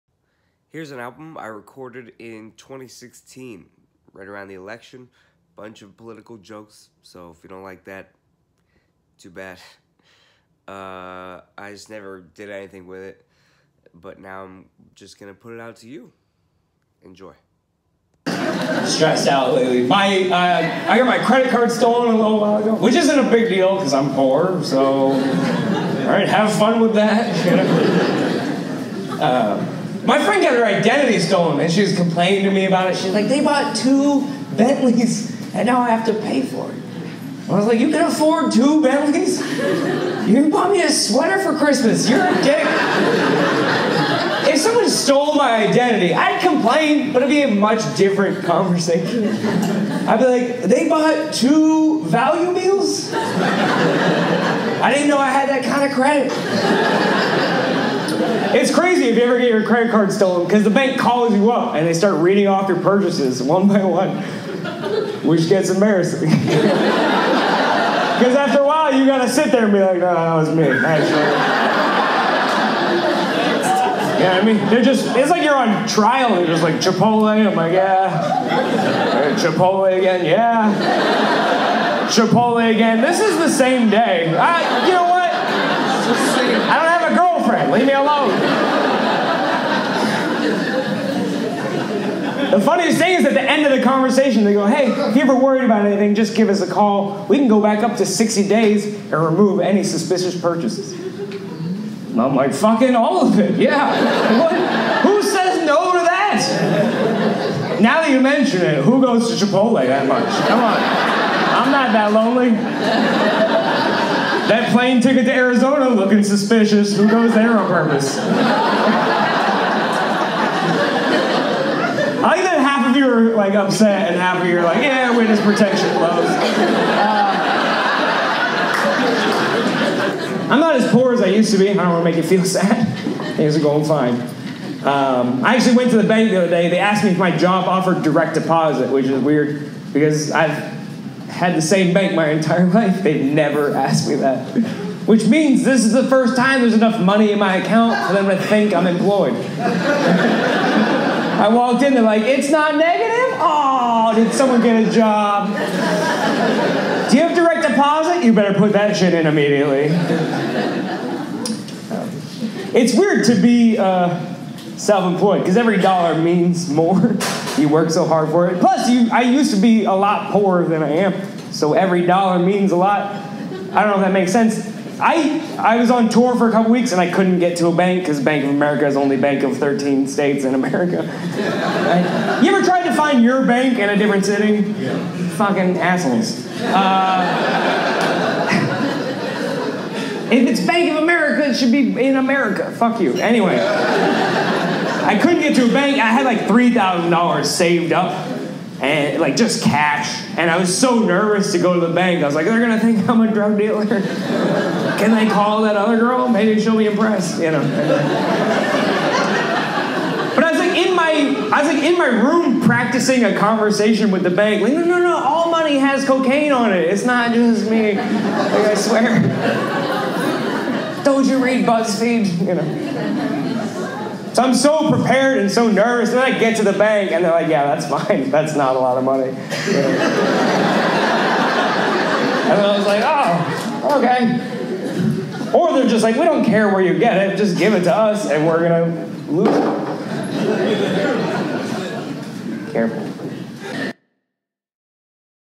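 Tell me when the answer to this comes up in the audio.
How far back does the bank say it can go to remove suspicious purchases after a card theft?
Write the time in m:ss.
1:38.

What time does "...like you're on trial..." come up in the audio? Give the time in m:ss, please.
1:15.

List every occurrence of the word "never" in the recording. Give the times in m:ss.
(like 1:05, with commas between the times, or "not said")
0:11, 2:23.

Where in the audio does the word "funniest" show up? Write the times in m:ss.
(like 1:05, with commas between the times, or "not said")
1:32.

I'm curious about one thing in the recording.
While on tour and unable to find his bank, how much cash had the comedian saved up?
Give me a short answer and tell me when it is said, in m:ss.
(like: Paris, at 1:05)
$3,000, at 3:16.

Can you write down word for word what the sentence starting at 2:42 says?
It's weird to be uh, self employed because every dollar means more.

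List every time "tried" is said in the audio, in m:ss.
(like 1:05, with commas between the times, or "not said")
3:02.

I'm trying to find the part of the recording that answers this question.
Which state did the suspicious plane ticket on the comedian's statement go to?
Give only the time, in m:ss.
1:55.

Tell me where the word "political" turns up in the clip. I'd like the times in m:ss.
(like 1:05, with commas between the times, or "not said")
0:05.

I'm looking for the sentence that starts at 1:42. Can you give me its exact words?
And I'm like, Fucking all of it, yeah.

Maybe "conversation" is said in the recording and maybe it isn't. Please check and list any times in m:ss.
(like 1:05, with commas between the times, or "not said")
0:48, 1:33, 3:33.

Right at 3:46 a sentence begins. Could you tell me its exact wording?
And then I get to the bank and they're like, yeah, that's fine.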